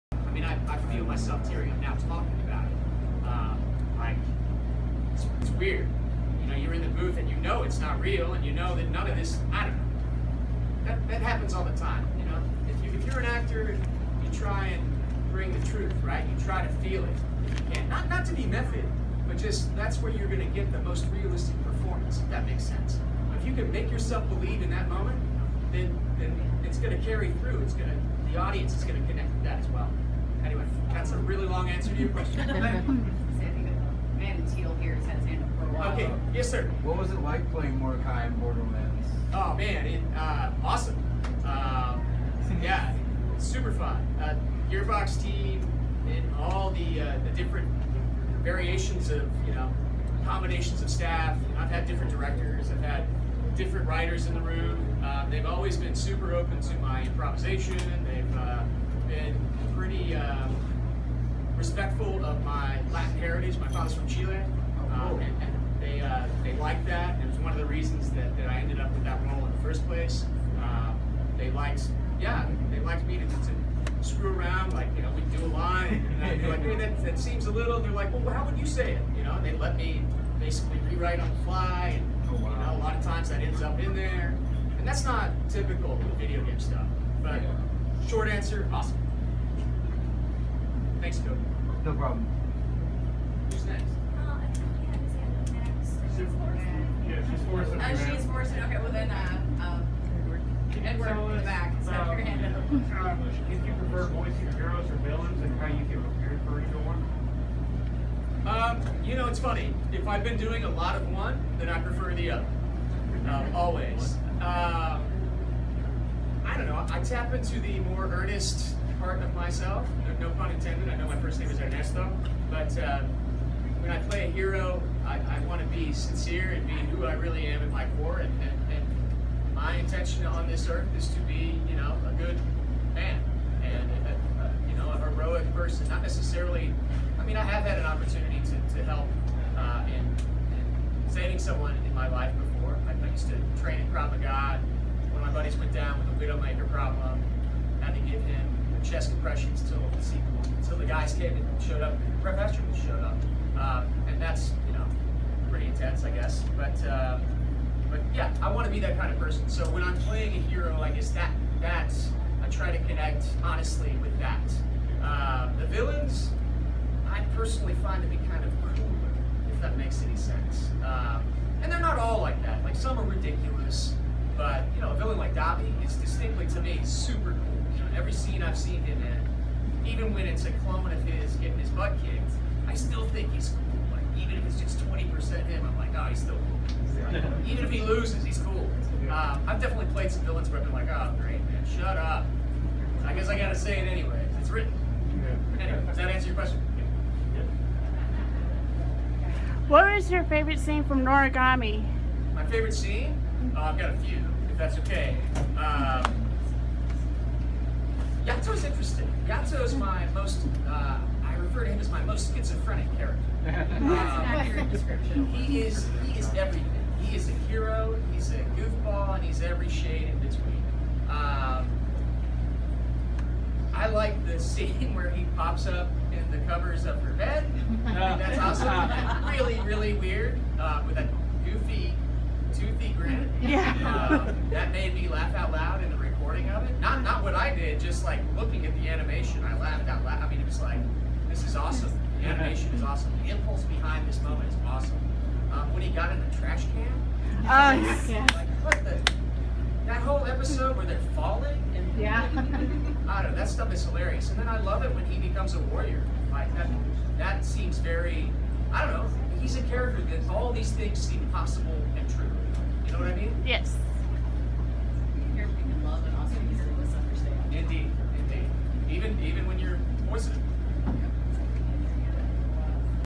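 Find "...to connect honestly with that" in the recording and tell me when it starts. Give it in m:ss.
2:42.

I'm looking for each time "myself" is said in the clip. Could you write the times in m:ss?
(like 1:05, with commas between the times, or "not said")
0:01, 1:59.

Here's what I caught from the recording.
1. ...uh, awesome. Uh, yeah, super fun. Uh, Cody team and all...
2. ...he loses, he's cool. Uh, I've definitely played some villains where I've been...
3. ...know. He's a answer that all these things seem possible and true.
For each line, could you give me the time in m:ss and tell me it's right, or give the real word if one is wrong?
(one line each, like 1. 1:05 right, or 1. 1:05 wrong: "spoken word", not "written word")
1. 0:40 wrong: "Gearbox", not "Cody"
2. 3:07 right
3. 4:18 wrong: "character", not "answer".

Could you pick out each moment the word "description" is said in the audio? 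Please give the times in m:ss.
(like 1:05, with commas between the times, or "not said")
3:34.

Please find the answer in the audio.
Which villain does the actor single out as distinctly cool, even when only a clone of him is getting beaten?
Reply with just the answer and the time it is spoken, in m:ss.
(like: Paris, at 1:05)
Dabi, at 2:55.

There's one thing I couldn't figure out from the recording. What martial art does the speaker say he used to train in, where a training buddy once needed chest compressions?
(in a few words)
Krav Maga.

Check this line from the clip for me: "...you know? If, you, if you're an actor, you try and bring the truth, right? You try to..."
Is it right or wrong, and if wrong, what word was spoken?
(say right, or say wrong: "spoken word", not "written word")
right.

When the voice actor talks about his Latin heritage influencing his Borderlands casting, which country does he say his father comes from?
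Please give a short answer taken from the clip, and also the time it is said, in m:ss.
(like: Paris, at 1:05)
Chile, at 1:04.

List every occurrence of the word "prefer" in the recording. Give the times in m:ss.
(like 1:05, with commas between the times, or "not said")
1:43, 1:51.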